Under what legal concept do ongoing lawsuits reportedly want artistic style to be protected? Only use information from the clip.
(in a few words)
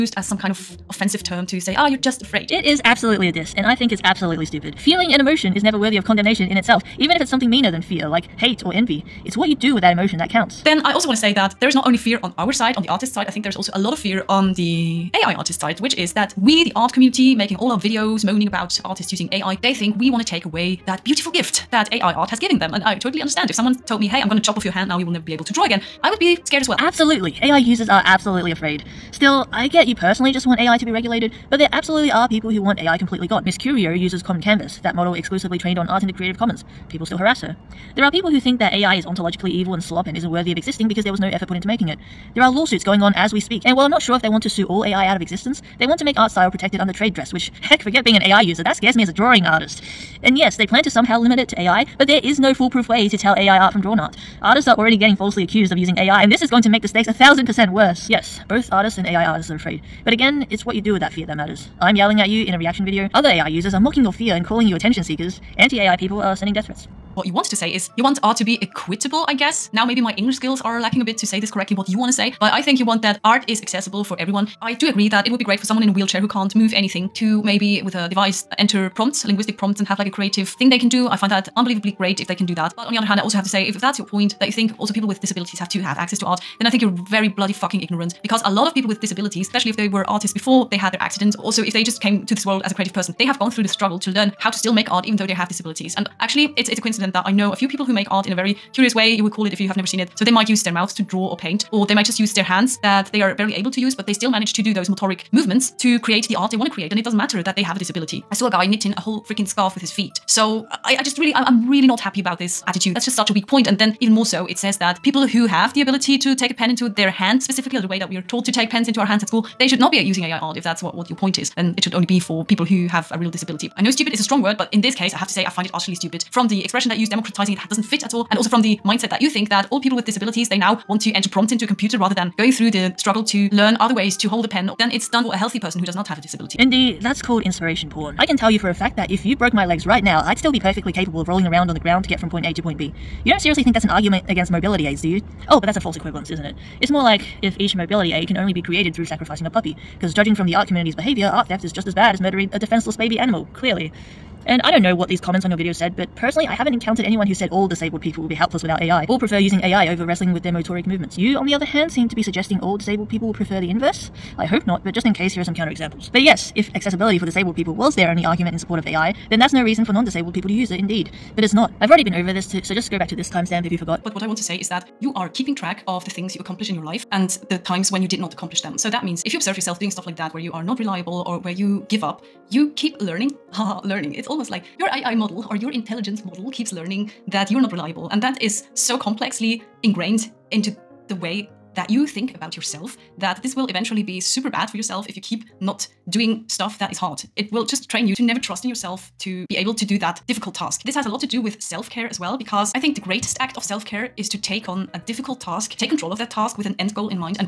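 trade dress.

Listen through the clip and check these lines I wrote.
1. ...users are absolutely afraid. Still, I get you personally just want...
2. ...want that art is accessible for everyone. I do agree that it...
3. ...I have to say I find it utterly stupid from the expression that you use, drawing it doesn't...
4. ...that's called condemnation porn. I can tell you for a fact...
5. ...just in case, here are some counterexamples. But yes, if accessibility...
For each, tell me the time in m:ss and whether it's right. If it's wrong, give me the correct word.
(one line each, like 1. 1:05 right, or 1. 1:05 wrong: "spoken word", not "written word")
1. 0:27 right
2. 1:12 right
3. 2:05 wrong: "democratizing", not "drawing"
4. 2:17 wrong: "inspiration", not "condemnation"
5. 2:44 right.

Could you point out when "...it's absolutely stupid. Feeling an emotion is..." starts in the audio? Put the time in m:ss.
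0:03.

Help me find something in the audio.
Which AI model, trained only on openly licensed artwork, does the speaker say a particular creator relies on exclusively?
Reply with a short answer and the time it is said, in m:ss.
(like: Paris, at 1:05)
Common Canvas, at 0:34.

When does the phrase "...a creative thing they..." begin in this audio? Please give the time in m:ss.
1:20.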